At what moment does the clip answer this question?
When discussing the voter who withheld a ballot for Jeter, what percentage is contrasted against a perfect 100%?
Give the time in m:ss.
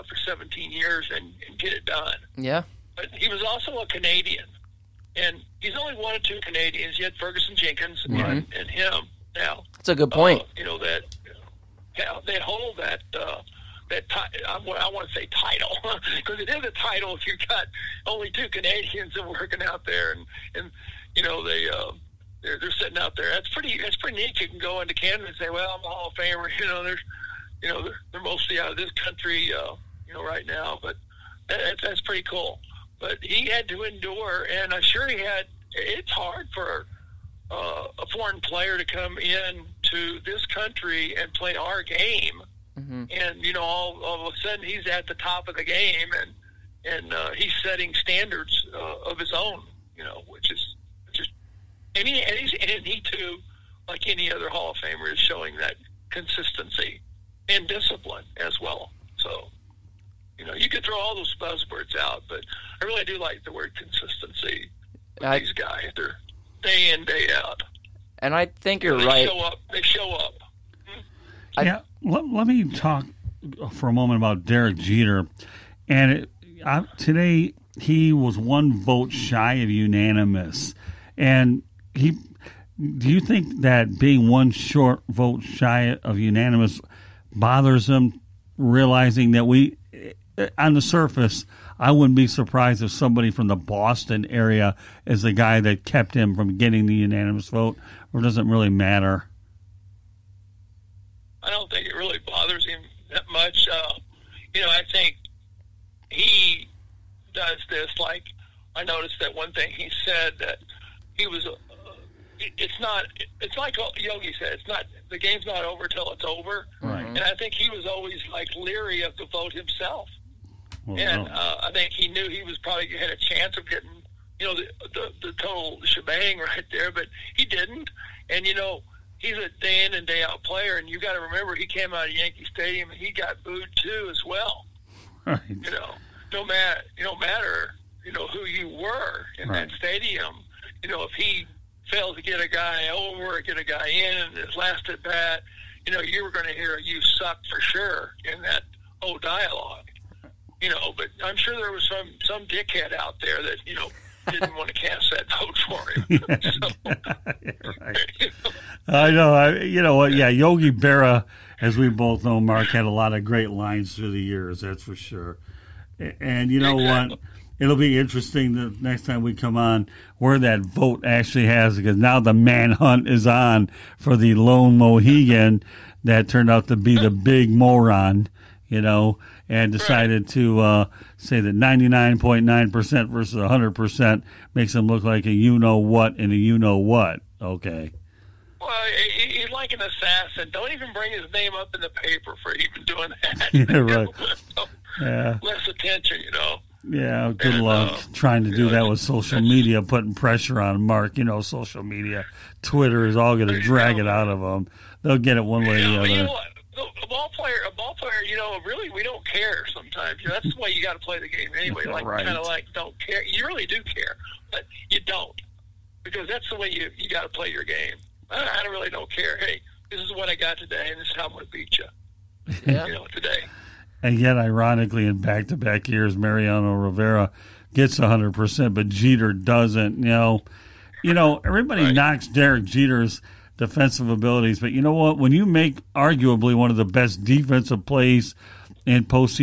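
3:01.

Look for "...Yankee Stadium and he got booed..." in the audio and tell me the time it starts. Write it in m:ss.
2:12.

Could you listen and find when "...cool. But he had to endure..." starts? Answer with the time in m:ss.
0:32.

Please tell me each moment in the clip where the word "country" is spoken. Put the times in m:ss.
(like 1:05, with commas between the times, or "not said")
0:28, 0:40.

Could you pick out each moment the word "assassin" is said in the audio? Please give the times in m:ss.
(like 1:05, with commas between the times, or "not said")
3:09.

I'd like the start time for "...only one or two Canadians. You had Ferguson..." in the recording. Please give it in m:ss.
0:05.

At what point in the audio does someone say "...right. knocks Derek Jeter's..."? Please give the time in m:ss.
3:51.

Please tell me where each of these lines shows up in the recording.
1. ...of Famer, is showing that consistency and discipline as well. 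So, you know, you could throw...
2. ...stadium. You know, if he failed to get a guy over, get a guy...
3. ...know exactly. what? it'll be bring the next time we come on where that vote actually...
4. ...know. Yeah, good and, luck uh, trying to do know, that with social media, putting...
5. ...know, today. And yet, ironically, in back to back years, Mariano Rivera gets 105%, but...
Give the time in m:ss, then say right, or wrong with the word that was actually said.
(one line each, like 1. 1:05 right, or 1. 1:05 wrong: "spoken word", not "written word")
1. 0:54 right
2. 2:19 right
3. 2:46 wrong: "interesting", not "bring"
4. 3:16 right
5. 3:42 wrong: "100", not "105".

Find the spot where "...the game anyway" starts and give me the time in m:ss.
3:31.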